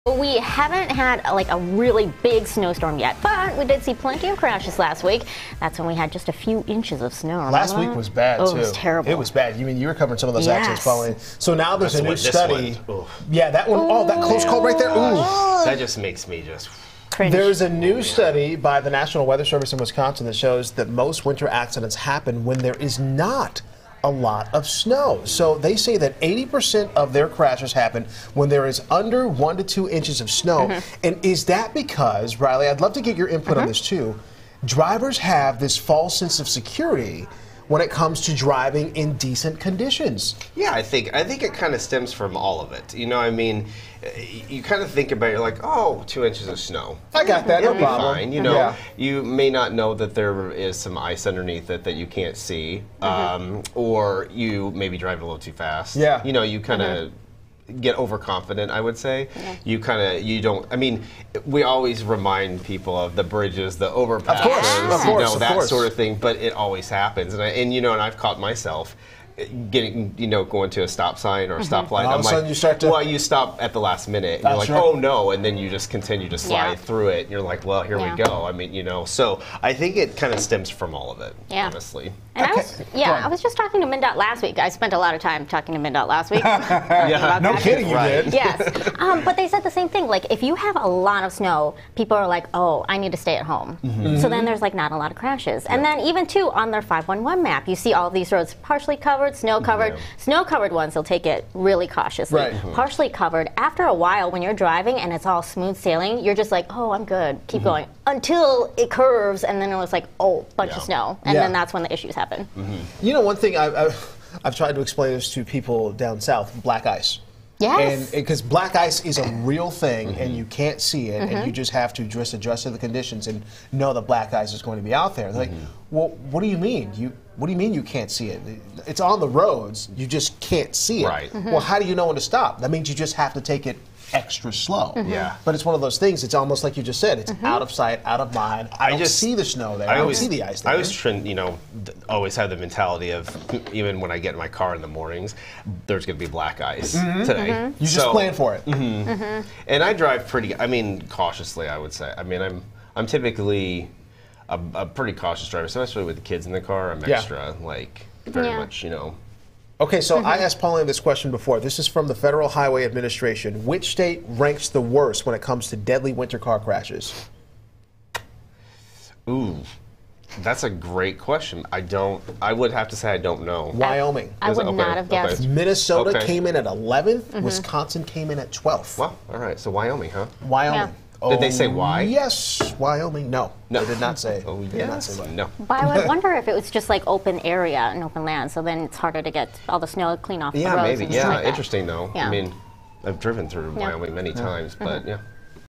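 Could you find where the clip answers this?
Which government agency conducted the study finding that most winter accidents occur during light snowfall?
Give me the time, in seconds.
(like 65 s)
18 s.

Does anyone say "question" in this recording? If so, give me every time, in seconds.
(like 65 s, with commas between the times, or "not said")
160 s, 171 s.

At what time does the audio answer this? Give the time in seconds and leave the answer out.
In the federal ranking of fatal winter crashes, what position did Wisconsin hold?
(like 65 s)
178 s.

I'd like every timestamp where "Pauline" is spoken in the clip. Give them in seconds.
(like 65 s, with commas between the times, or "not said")
10 s, 160 s.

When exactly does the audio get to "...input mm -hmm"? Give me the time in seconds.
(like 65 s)
33 s.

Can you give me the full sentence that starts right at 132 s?
That means you just have to take it extra slow.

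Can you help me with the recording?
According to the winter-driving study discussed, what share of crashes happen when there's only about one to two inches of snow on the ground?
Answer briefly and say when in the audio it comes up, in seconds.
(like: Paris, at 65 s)
80%, at 26 s.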